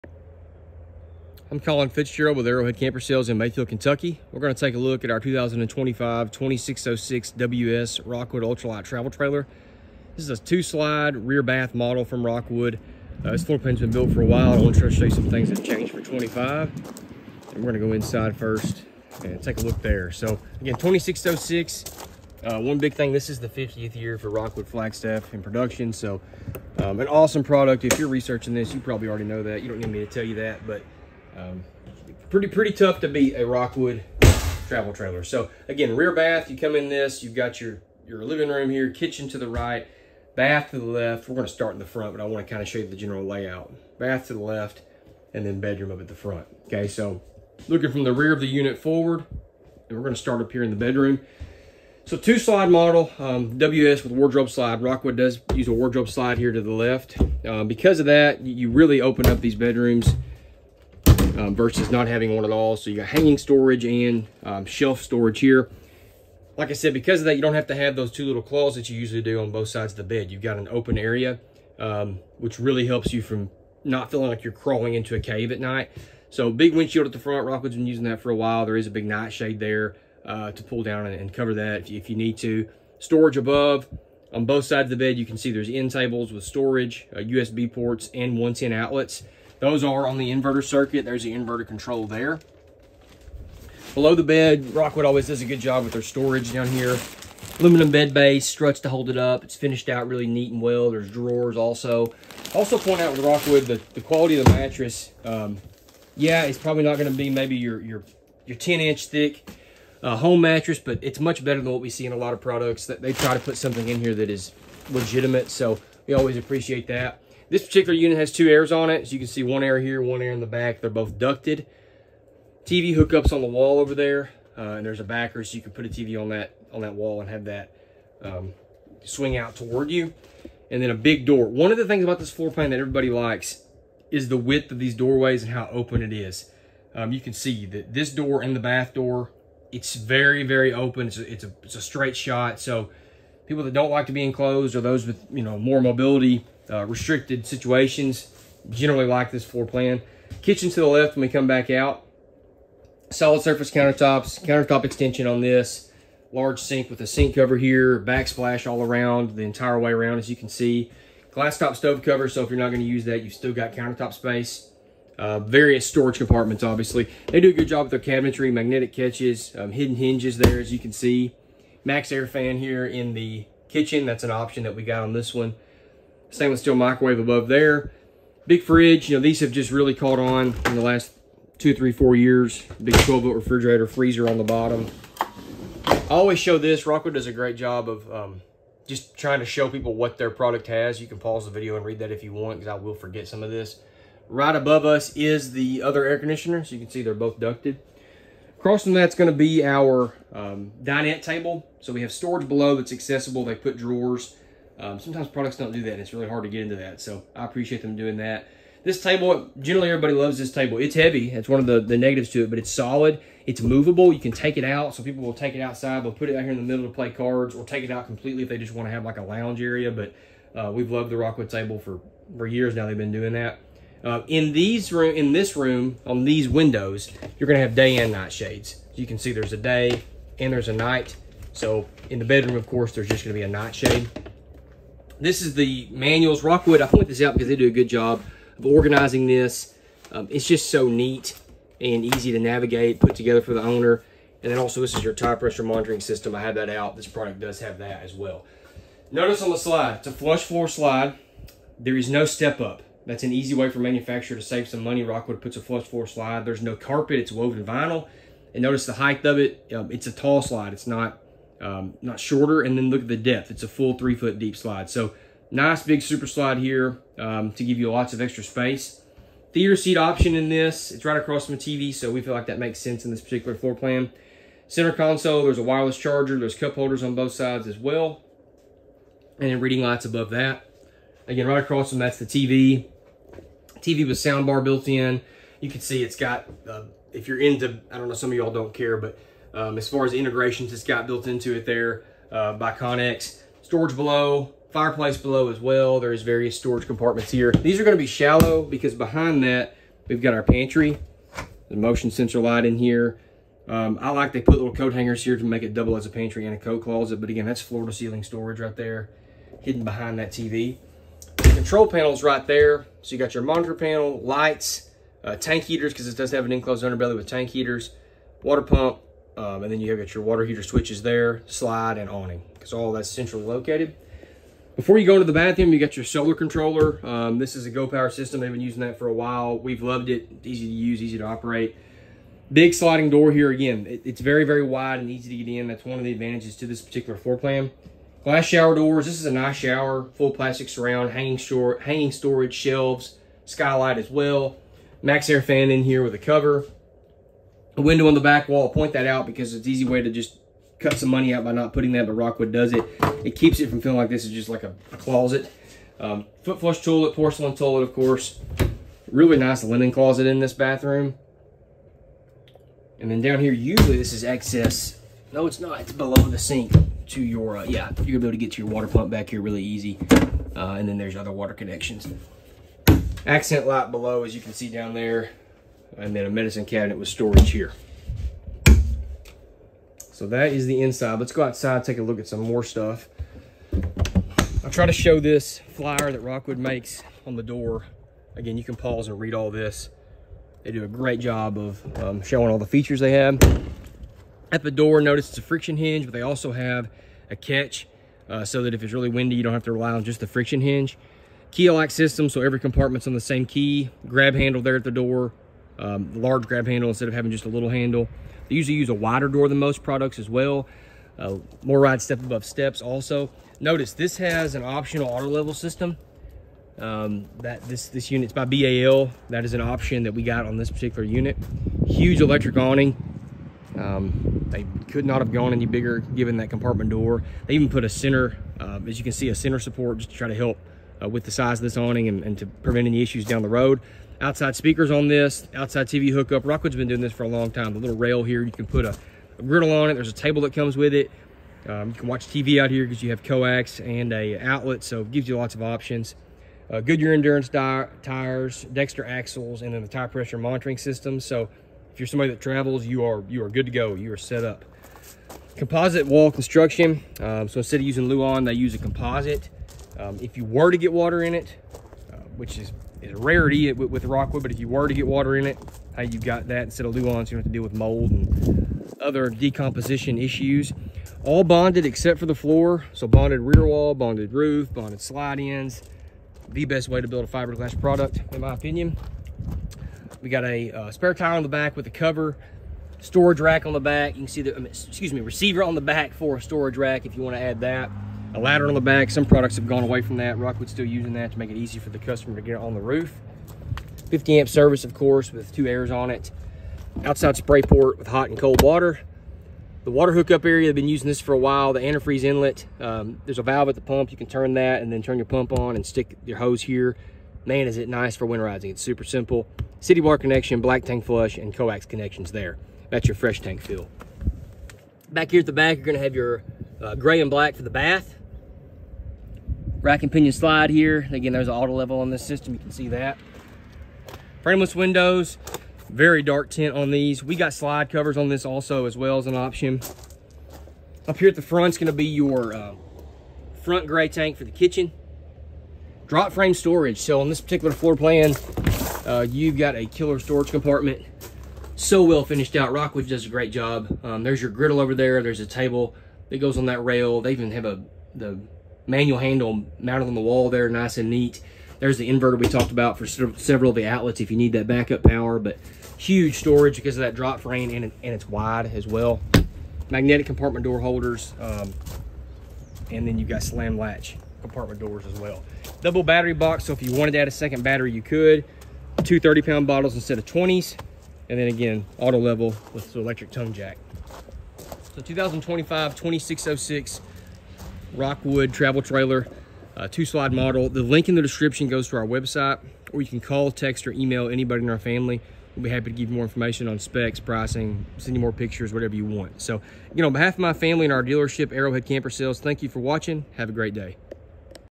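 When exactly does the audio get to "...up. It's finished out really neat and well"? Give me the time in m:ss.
1:39.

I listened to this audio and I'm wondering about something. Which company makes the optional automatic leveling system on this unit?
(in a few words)
BAL.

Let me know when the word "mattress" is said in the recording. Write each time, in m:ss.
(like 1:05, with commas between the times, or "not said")
1:44, 1:50.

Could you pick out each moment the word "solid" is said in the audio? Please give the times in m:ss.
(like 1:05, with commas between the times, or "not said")
2:33, 3:32.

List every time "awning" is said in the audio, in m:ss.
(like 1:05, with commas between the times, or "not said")
5:22, 7:02, 7:11.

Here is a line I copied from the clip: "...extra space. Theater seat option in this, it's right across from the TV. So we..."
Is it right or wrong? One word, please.
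right.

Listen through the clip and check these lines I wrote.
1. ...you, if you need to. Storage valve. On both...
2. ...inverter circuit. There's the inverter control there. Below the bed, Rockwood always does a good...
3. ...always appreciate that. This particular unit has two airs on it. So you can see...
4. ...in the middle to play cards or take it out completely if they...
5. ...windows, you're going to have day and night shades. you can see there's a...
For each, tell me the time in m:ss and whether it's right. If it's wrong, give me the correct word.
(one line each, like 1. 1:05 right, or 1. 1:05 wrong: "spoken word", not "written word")
1. 1:21 wrong: "above", not "valve"
2. 1:30 right
3. 1:56 right
4. 3:36 right
5. 3:46 right.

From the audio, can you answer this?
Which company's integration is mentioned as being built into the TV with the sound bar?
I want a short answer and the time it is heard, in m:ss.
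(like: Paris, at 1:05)
Connex, at 4:52.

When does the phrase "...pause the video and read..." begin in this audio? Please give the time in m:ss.
3:11.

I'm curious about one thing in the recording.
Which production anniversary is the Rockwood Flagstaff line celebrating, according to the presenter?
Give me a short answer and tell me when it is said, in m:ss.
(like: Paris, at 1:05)
50th, at 0:23.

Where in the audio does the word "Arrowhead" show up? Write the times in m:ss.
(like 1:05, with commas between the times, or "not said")
0:02, 9:51.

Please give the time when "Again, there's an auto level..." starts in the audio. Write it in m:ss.
8:41.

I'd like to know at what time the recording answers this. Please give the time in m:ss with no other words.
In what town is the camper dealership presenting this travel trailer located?
0:03.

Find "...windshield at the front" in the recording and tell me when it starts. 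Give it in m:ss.
1:16.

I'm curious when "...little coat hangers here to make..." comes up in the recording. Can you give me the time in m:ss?
5:04.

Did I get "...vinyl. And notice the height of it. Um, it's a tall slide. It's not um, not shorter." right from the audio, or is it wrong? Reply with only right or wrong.
right.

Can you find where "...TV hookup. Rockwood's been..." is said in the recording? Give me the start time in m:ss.
7:15.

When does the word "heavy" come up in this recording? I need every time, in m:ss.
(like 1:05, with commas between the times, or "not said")
3:30.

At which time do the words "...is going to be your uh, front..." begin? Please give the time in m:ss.
8:51.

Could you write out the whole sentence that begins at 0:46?
Okay, so looking from the rear of the unit forward, and we're gonna start up here in the bedroom.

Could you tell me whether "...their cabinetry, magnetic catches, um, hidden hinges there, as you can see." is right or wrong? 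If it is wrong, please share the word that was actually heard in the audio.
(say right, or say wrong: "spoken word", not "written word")
right.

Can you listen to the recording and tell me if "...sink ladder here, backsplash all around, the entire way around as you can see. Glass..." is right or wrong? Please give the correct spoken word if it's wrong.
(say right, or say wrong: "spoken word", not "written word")
wrong: "cover", not "ladder".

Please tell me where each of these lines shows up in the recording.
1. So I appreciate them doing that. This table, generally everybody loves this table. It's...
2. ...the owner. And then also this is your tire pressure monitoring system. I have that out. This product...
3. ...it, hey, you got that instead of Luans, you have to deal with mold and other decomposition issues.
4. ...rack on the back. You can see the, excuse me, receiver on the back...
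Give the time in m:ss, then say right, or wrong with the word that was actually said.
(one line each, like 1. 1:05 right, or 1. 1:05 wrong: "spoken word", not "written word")
1. 3:26 right
2. 4:03 right
3. 7:45 right
4. 8:03 right.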